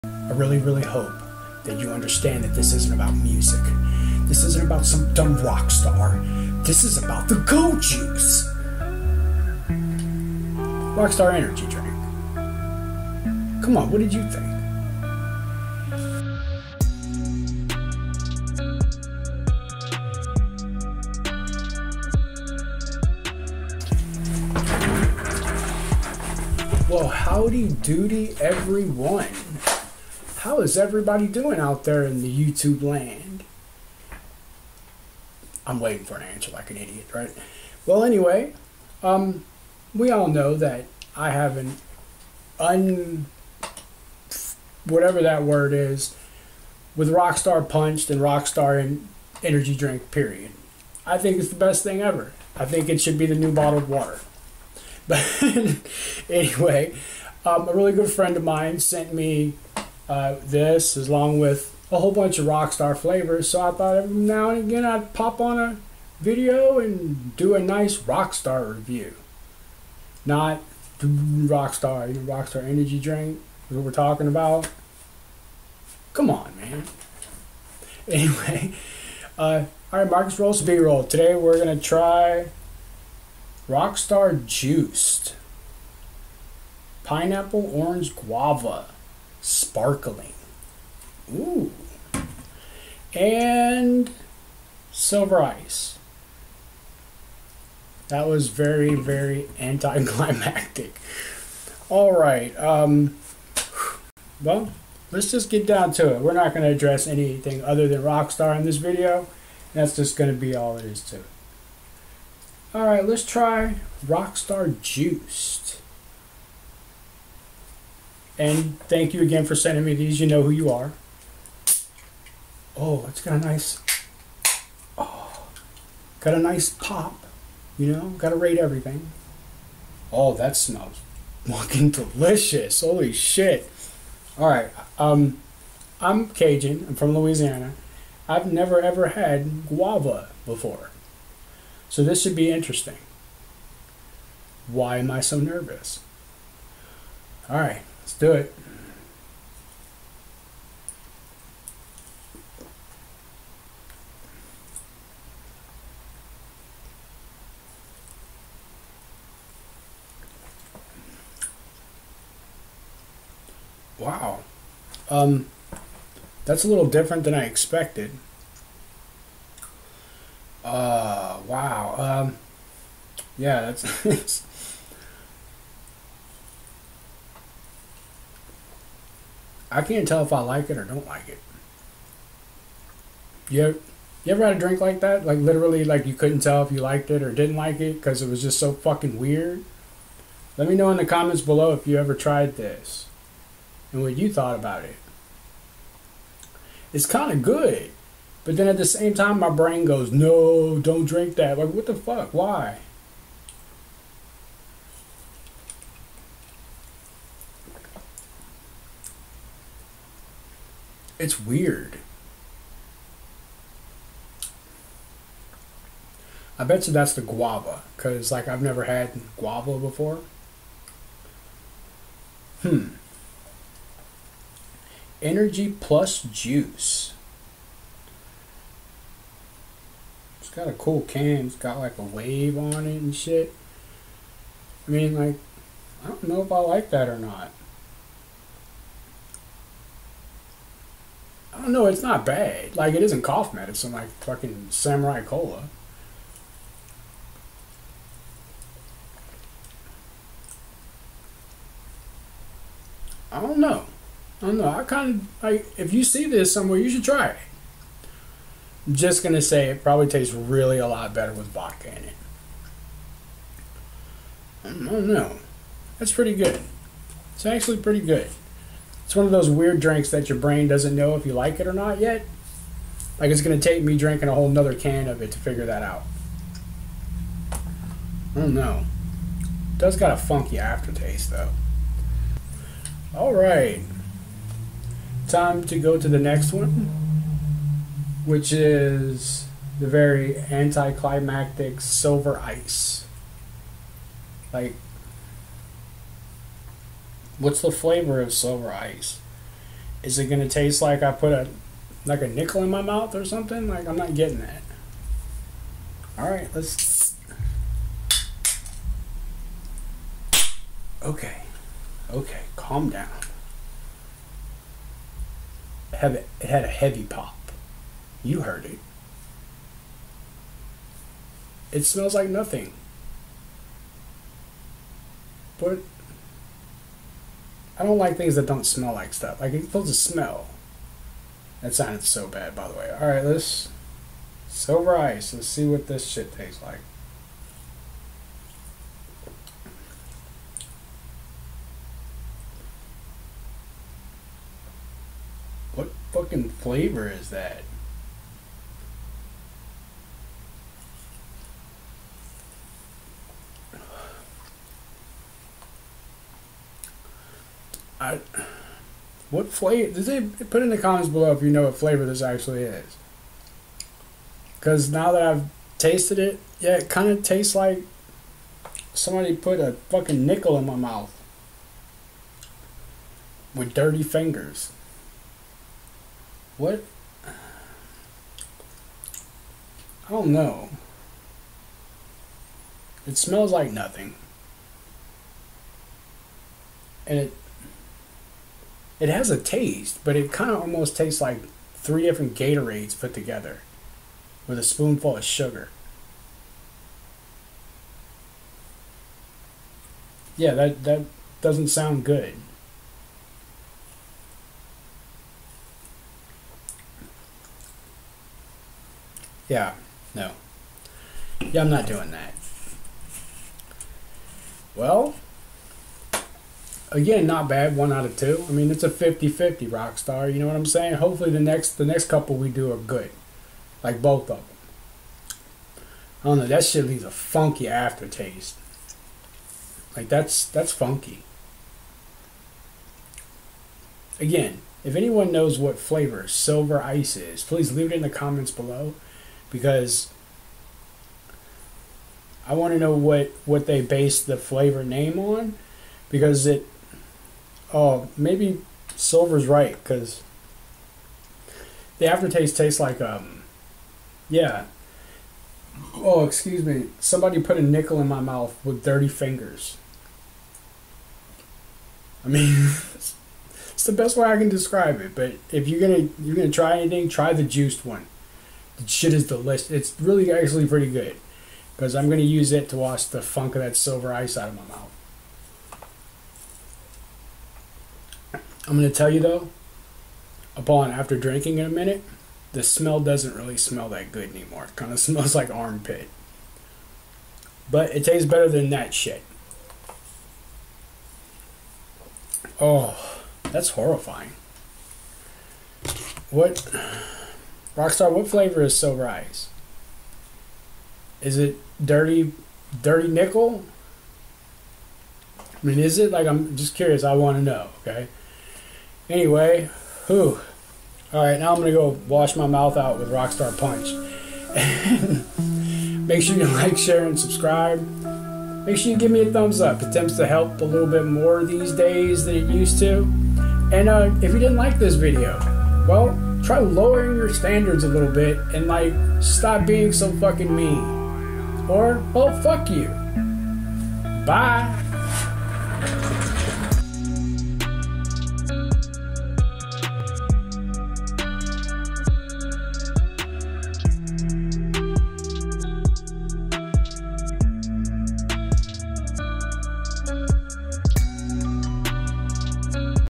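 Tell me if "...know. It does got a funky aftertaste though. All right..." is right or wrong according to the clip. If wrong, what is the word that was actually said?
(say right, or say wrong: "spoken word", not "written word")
right.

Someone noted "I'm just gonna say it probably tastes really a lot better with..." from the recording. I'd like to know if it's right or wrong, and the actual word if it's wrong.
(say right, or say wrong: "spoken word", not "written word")
right.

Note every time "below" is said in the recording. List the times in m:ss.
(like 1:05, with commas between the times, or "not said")
3:11, 6:01, 7:18.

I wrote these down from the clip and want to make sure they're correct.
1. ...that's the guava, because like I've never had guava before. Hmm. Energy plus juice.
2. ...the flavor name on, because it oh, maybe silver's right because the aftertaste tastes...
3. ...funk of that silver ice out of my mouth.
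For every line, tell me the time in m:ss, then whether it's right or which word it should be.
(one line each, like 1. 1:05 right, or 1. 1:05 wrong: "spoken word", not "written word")
1. 3:36 right
2. 7:24 right
3. 7:53 right.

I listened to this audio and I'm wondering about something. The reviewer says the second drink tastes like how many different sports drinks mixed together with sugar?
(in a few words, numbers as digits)
3.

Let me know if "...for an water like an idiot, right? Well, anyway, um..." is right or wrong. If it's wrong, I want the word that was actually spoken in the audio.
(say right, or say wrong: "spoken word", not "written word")
wrong: "answer", not "water".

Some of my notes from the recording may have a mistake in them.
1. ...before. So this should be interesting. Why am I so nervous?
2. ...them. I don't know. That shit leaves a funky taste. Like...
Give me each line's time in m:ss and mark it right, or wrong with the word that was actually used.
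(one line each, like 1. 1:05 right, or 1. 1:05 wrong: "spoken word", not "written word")
1. 2:20 right
2. 7:04 wrong: "aftertaste", not "taste".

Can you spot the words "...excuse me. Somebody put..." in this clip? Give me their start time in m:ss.
7:36.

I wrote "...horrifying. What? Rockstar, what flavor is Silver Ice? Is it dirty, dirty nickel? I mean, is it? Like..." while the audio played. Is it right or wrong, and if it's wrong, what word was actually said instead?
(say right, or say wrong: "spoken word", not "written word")
right.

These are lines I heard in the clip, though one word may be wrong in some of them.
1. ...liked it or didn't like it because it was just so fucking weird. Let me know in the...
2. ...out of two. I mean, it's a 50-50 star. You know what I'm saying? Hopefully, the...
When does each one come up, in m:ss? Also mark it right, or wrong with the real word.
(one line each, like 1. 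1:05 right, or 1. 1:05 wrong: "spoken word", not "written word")
1. 3:06 right
2. 6:57 right.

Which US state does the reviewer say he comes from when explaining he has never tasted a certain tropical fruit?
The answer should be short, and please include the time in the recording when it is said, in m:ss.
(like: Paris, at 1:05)
Louisiana, at 2:17.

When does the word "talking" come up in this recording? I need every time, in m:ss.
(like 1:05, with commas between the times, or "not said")
1:13.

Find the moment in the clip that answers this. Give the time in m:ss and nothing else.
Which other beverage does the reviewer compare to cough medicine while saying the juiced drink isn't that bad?
4:04.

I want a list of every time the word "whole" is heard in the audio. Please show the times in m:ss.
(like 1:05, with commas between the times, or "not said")
1:01, 4:34.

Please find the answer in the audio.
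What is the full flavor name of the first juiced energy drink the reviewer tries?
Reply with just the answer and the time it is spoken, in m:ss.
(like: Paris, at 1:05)
Pineapple orange guava, at 1:27.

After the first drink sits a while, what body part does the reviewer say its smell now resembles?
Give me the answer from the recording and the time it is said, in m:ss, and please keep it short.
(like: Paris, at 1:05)
Armpit, at 8:05.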